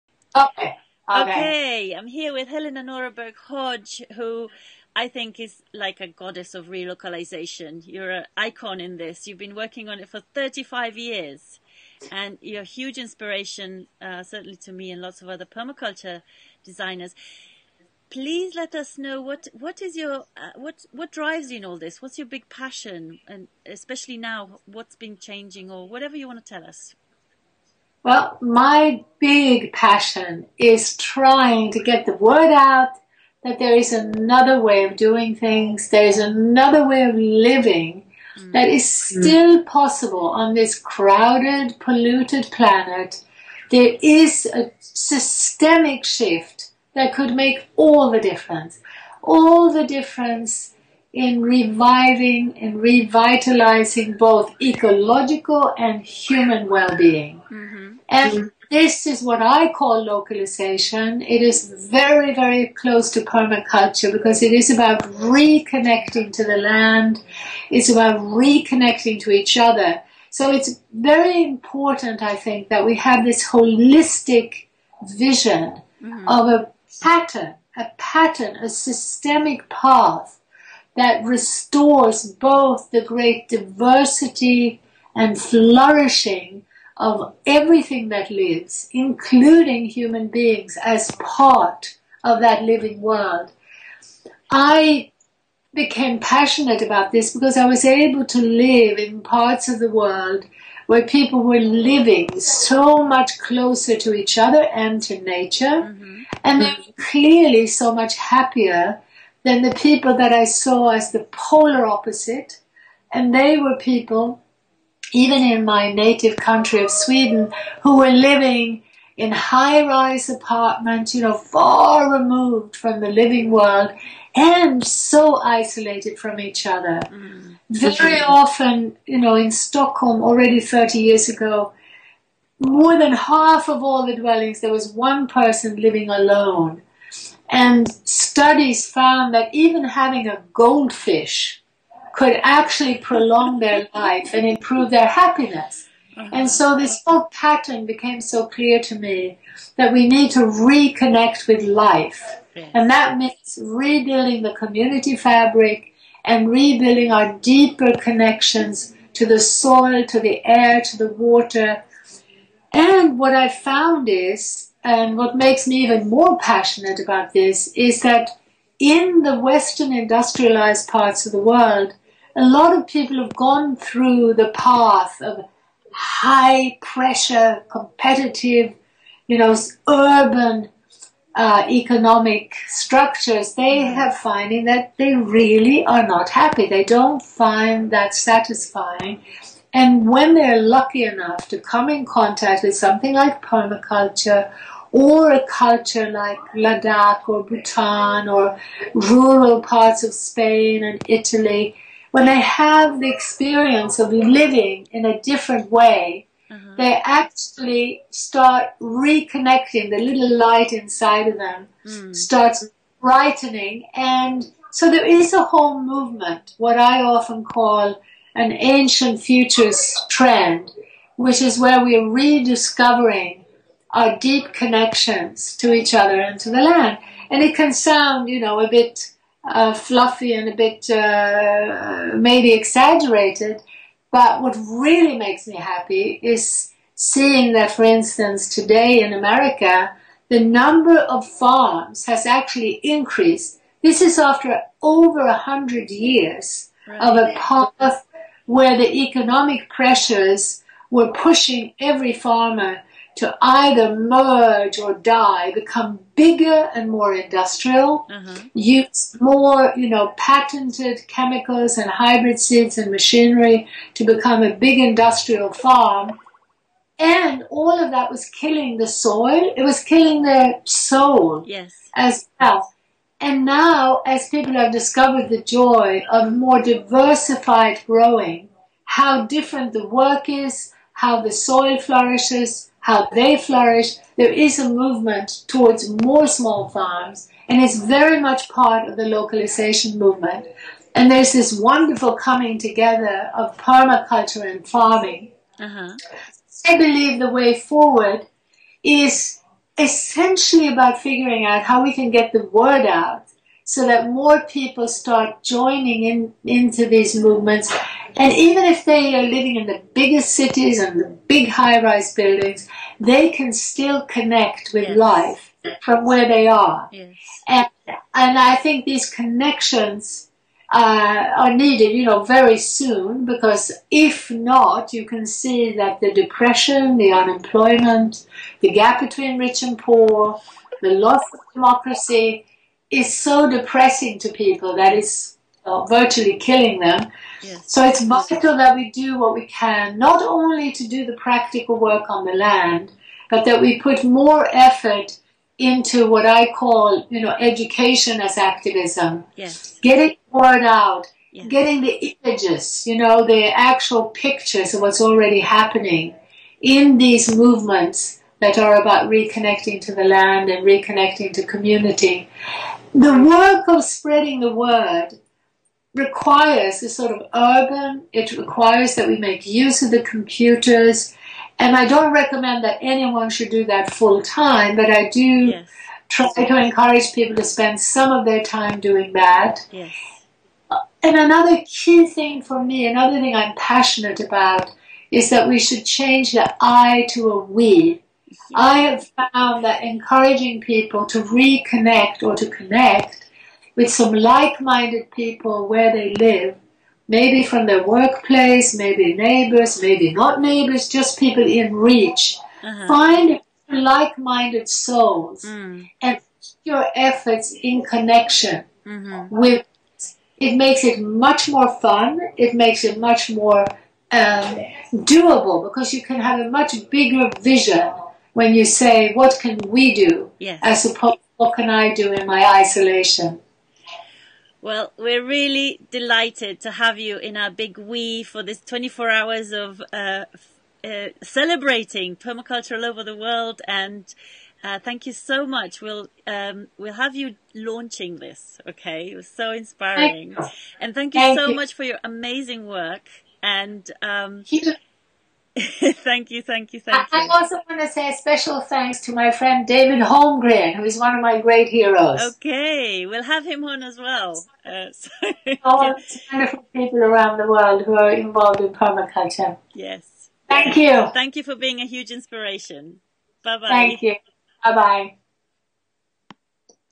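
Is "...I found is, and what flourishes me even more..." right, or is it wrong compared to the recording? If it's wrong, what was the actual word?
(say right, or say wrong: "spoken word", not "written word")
wrong: "makes", not "flourishes".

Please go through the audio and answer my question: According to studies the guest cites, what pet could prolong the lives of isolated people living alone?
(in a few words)
a goldfish.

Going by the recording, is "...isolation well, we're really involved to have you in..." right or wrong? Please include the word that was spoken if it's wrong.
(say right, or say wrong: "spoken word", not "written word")
wrong: "delighted", not "involved".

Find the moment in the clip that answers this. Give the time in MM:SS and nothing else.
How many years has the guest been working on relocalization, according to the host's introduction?
00:10.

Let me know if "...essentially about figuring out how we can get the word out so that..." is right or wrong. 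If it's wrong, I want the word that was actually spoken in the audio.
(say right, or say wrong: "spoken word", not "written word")
right.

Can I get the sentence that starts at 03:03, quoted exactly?
have finding that they really are not happy.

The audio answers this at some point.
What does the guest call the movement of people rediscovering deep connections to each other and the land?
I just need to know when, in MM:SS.
03:38.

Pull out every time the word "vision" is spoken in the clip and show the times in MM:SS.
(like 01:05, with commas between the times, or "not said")
01:15, 06:57.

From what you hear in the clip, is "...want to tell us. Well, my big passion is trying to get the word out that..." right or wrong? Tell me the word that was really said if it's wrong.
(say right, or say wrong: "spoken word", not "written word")
right.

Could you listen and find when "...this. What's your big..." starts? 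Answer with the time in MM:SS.
00:21.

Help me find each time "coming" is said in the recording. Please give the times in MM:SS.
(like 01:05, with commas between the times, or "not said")
04:52.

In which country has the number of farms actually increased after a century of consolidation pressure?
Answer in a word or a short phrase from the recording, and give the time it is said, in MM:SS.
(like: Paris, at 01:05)
America, at 03:59.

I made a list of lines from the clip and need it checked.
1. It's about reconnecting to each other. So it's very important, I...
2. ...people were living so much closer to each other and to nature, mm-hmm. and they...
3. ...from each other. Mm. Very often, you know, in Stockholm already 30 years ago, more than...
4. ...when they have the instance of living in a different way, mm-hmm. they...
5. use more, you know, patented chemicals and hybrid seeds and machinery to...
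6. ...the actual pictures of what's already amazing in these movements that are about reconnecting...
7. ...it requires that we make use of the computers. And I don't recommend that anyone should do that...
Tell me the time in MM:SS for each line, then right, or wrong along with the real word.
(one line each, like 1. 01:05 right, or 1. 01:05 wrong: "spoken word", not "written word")
1. 01:07 right
2. 01:41 right
3. 02:06 right
4. 03:22 wrong: "experience", not "instance"
5. 04:18 right
6. 05:53 wrong: "happening", not "amazing"
7. 06:08 right.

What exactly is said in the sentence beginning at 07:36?
wonderful people around the world who are involved in permaculture.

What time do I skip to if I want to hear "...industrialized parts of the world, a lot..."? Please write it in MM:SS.
02:49.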